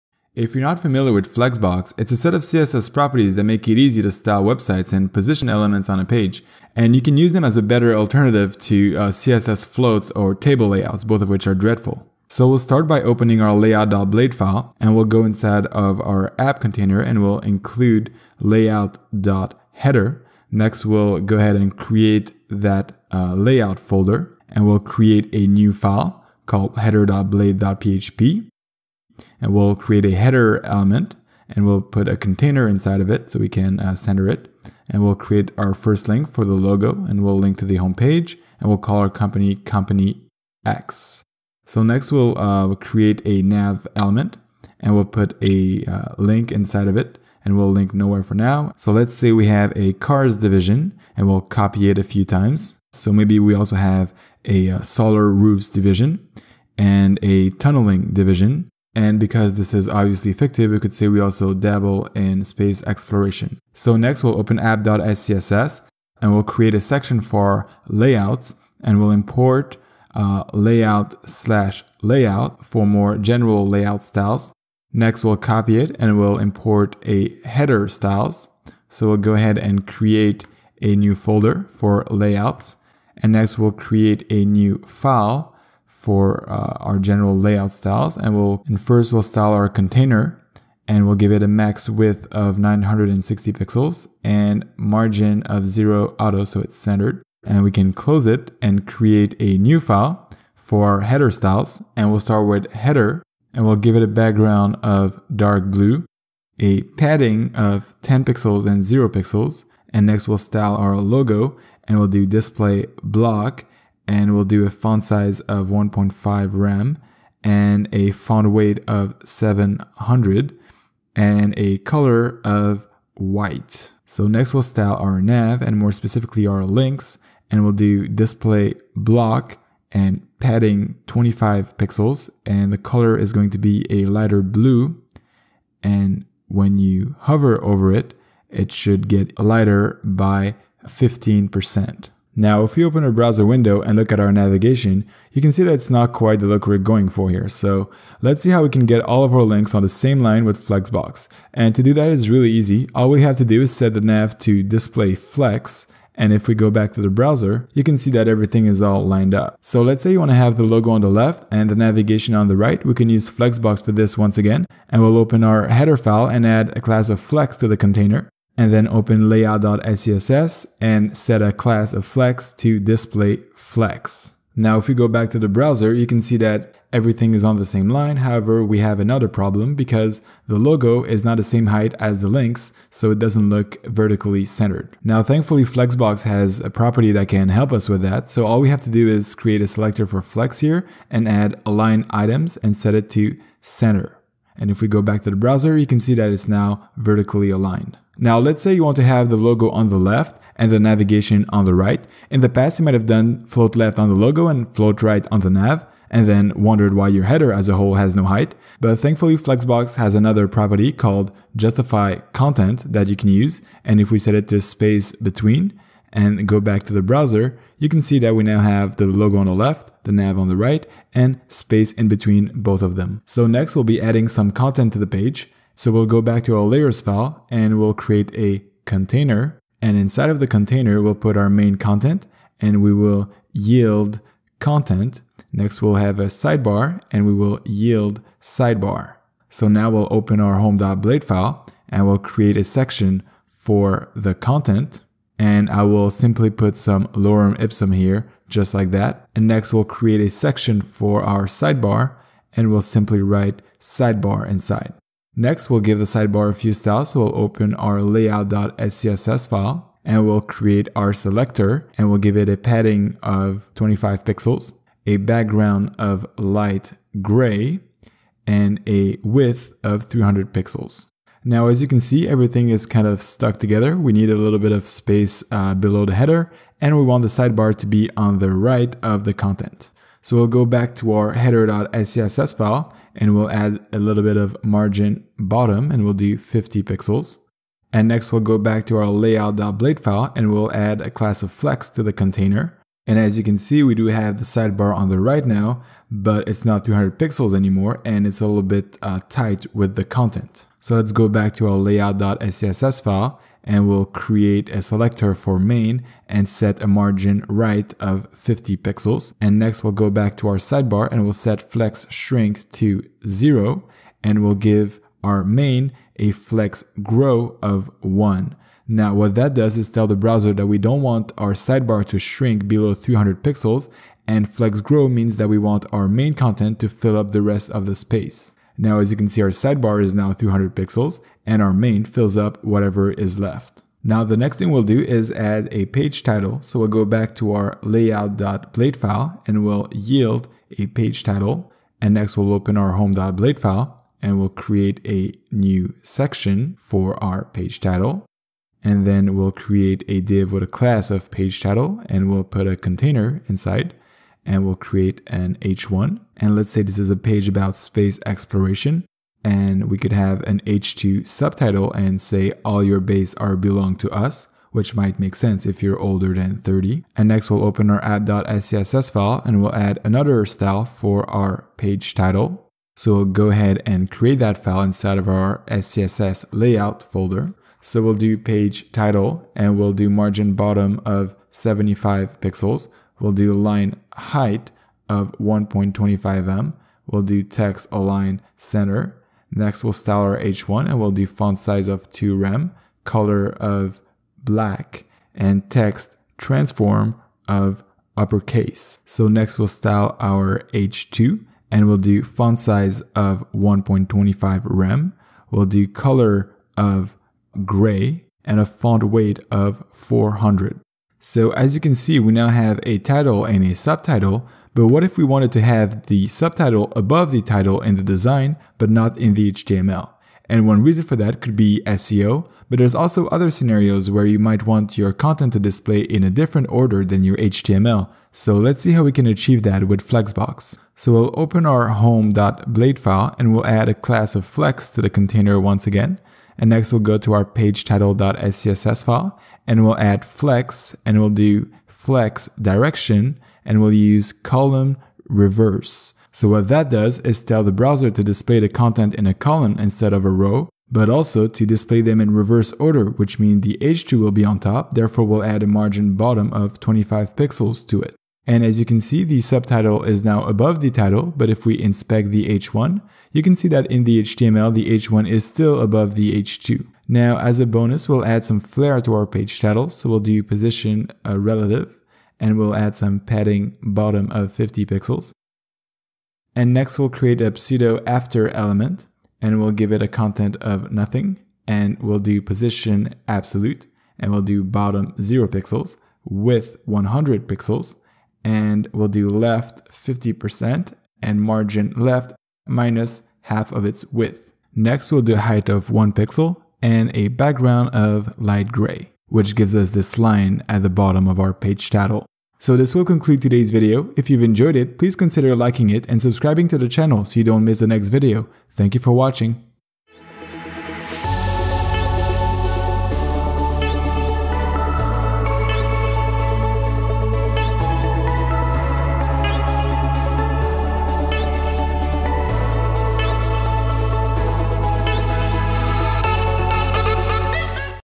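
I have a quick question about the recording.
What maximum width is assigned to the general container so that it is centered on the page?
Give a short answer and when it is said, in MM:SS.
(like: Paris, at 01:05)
960 pixels, at 01:32.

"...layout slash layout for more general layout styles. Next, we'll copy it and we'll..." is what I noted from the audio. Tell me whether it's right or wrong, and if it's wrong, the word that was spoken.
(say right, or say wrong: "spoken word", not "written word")
right.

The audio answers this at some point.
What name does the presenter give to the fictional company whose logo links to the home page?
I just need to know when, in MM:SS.
00:39.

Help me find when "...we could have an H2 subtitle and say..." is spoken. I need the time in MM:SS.
05:59.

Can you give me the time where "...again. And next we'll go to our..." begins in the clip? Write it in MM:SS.
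07:15.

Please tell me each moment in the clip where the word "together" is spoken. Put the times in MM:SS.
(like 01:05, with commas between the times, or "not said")
04:33.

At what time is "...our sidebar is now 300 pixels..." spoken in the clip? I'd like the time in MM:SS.
05:29.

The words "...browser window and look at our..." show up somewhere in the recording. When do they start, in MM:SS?
02:23.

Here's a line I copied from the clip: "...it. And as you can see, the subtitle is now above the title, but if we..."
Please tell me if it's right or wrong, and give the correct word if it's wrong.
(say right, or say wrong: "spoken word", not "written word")
right.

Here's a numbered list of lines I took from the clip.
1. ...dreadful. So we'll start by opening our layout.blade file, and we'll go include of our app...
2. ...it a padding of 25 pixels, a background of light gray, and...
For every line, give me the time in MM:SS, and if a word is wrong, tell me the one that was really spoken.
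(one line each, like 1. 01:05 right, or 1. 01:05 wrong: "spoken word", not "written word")
1. 00:11 wrong: "inside", not "include"
2. 04:22 right.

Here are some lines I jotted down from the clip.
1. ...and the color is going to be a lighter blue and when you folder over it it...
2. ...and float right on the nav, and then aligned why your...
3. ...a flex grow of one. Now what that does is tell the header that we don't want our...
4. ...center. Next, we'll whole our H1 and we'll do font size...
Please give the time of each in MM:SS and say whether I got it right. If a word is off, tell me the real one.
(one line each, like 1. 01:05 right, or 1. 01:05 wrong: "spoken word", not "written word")
1. 02:12 wrong: "hover", not "folder"
2. 03:24 wrong: "wondered", not "aligned"
3. 05:16 wrong: "browser", not "header"
4. 06:28 wrong: "style", not "whole".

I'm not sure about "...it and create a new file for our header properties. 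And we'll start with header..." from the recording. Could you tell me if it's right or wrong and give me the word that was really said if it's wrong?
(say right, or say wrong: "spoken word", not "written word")
wrong: "styles", not "properties".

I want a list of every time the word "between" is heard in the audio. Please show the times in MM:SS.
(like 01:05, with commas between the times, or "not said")
03:35, 03:42.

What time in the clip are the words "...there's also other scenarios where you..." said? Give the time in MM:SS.
07:02.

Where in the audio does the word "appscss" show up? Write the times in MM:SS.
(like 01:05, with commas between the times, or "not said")
01:04, 06:08.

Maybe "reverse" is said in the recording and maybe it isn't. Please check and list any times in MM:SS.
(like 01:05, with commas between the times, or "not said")
07:25, 07:32.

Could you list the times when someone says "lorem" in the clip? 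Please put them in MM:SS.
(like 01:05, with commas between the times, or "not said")
04:07.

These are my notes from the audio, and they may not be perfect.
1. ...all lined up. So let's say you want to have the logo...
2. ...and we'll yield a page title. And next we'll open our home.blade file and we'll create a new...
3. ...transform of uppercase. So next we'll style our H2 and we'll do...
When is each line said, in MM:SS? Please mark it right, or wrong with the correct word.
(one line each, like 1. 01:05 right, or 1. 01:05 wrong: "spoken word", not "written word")
1. 02:38 right
2. 05:39 right
3. 06:36 right.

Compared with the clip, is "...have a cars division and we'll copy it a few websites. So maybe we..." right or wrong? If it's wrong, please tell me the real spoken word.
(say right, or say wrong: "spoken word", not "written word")
wrong: "times", not "websites".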